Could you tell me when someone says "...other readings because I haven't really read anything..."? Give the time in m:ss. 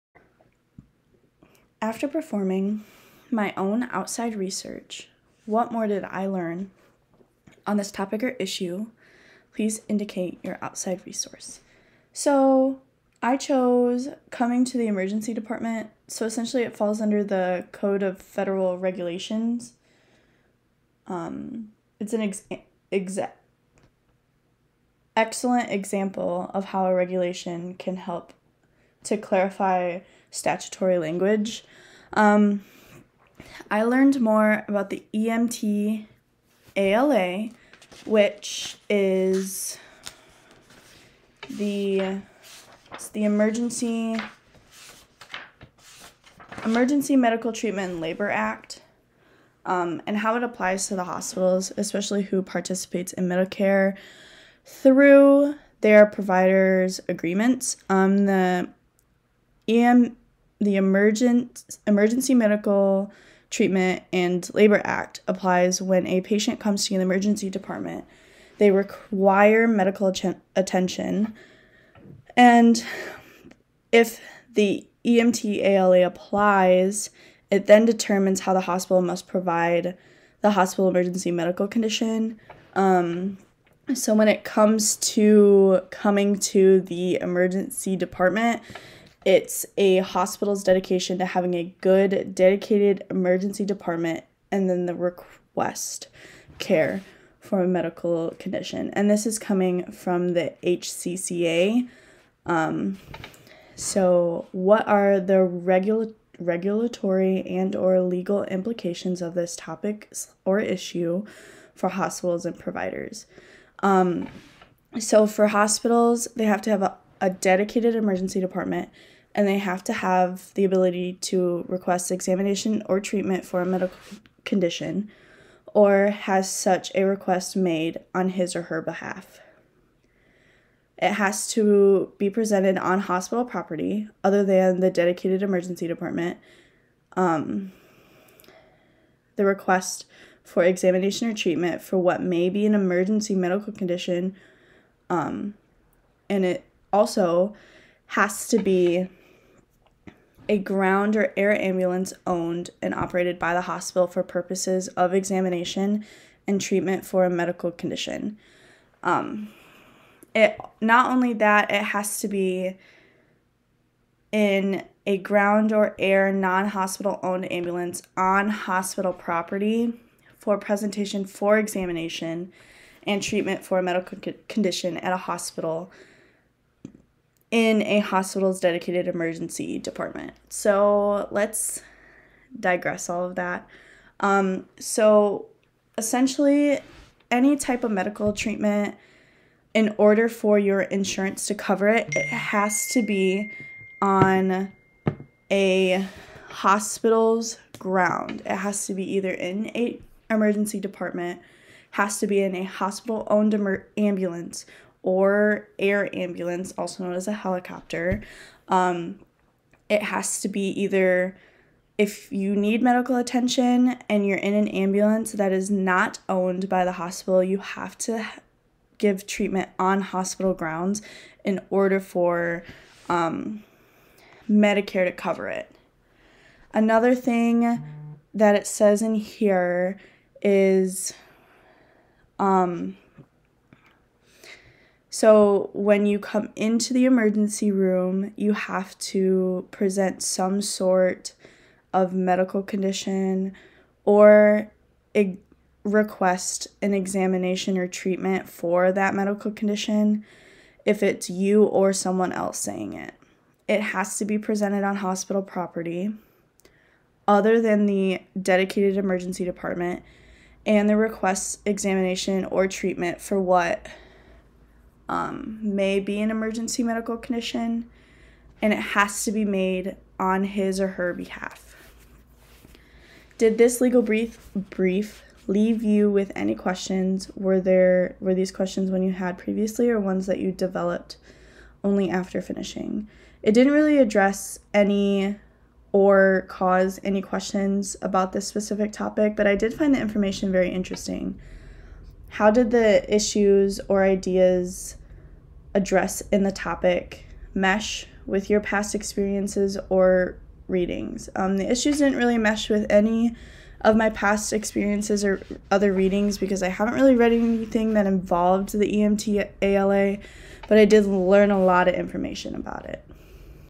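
5:05.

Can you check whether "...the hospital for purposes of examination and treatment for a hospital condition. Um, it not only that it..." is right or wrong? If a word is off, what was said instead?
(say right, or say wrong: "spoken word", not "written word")
wrong: "medical", not "hospital".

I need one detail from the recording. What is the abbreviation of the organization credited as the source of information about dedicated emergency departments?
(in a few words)
HCCA.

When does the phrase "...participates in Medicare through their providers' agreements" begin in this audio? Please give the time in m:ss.
0:52.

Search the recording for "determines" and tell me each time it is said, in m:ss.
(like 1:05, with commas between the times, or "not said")
1:17.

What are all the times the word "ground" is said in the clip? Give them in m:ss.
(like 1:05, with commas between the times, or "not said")
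2:30, 2:45, 3:17, 3:40.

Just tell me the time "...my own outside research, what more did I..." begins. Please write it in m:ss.
0:03.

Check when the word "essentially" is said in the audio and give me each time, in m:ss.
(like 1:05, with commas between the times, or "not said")
0:16, 3:05.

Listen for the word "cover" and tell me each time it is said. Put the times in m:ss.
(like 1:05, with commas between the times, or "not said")
3:11, 3:45.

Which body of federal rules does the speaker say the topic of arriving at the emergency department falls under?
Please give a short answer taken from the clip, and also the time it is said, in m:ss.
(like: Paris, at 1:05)
Code of Federal Regulations, at 0:17.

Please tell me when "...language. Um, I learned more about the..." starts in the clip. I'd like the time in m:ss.
0:30.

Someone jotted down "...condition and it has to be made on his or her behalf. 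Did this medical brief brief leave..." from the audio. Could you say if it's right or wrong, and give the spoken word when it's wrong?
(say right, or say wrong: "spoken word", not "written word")
wrong: "legal", not "medical".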